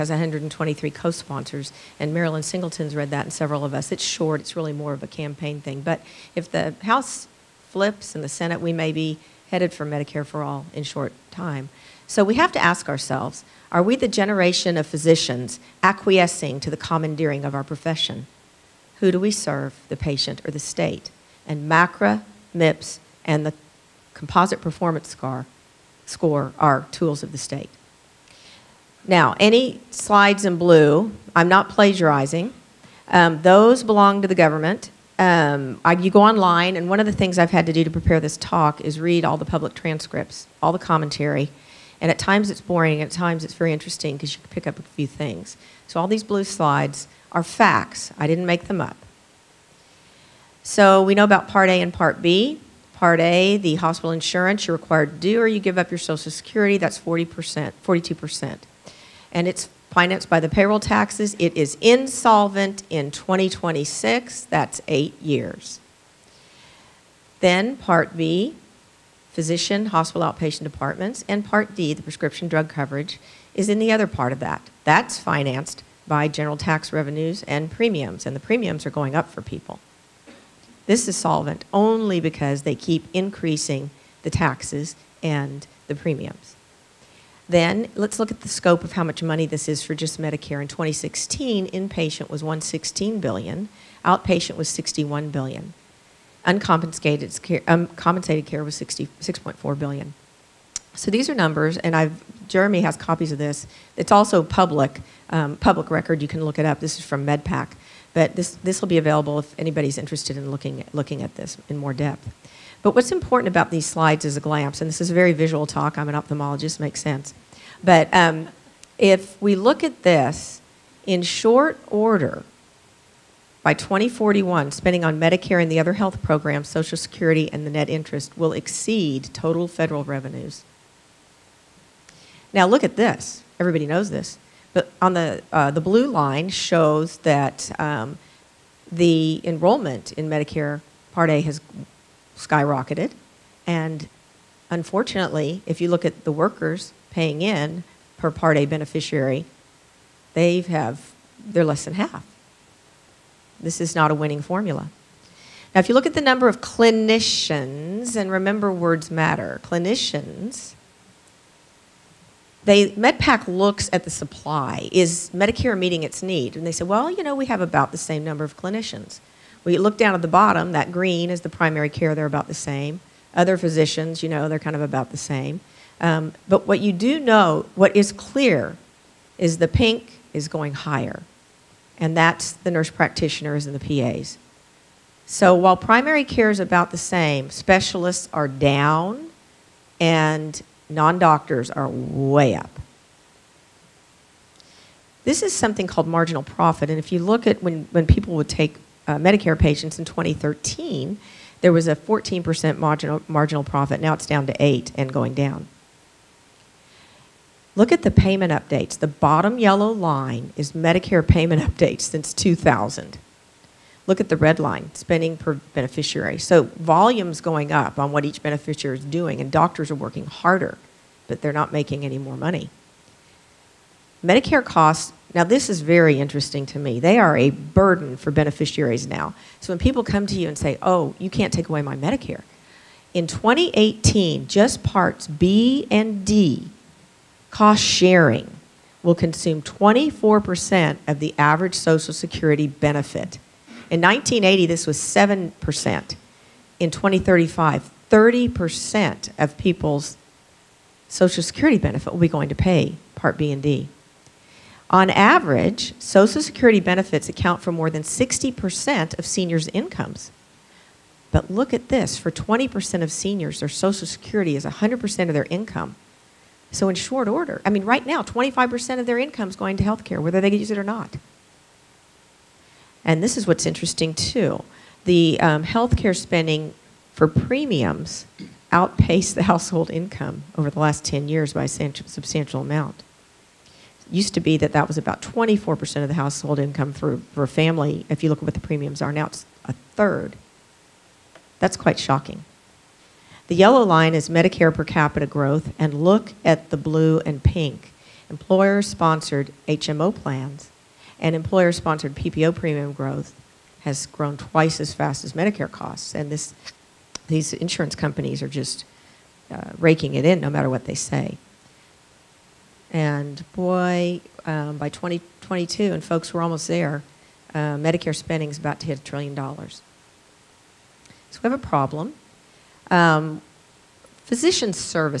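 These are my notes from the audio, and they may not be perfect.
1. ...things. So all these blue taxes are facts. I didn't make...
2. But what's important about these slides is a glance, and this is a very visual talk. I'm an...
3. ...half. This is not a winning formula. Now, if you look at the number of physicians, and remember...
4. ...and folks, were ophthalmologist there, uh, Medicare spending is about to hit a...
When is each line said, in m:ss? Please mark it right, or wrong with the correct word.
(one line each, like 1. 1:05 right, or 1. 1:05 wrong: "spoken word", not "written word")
1. 0:45 wrong: "slides", not "taxes"
2. 1:52 right
3. 2:31 wrong: "clinicians", not "physicians"
4. 5:15 wrong: "almost", not "ophthalmologist".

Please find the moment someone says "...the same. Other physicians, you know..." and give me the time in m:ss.
2:52.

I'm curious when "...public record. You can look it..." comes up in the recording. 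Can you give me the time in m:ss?
1:45.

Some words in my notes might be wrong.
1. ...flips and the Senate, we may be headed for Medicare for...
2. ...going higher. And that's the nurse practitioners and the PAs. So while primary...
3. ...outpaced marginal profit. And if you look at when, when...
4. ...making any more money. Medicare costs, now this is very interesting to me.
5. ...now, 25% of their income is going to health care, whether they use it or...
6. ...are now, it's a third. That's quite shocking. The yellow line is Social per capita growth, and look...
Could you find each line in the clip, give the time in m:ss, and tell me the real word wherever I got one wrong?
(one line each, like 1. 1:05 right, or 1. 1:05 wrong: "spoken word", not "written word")
1. 0:07 right
2. 3:00 right
3. 3:15 wrong: "called", not "outpaced"
4. 3:41 right
5. 4:28 right
6. 4:49 wrong: "Medicare", not "Social".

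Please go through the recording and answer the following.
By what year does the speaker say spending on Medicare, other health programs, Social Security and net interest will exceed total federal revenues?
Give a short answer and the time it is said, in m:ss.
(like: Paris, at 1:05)
2041, at 2:03.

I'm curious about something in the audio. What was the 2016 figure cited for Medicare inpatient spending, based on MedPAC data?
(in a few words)
116 billion.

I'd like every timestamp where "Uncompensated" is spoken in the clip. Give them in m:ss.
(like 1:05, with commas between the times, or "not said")
1:36.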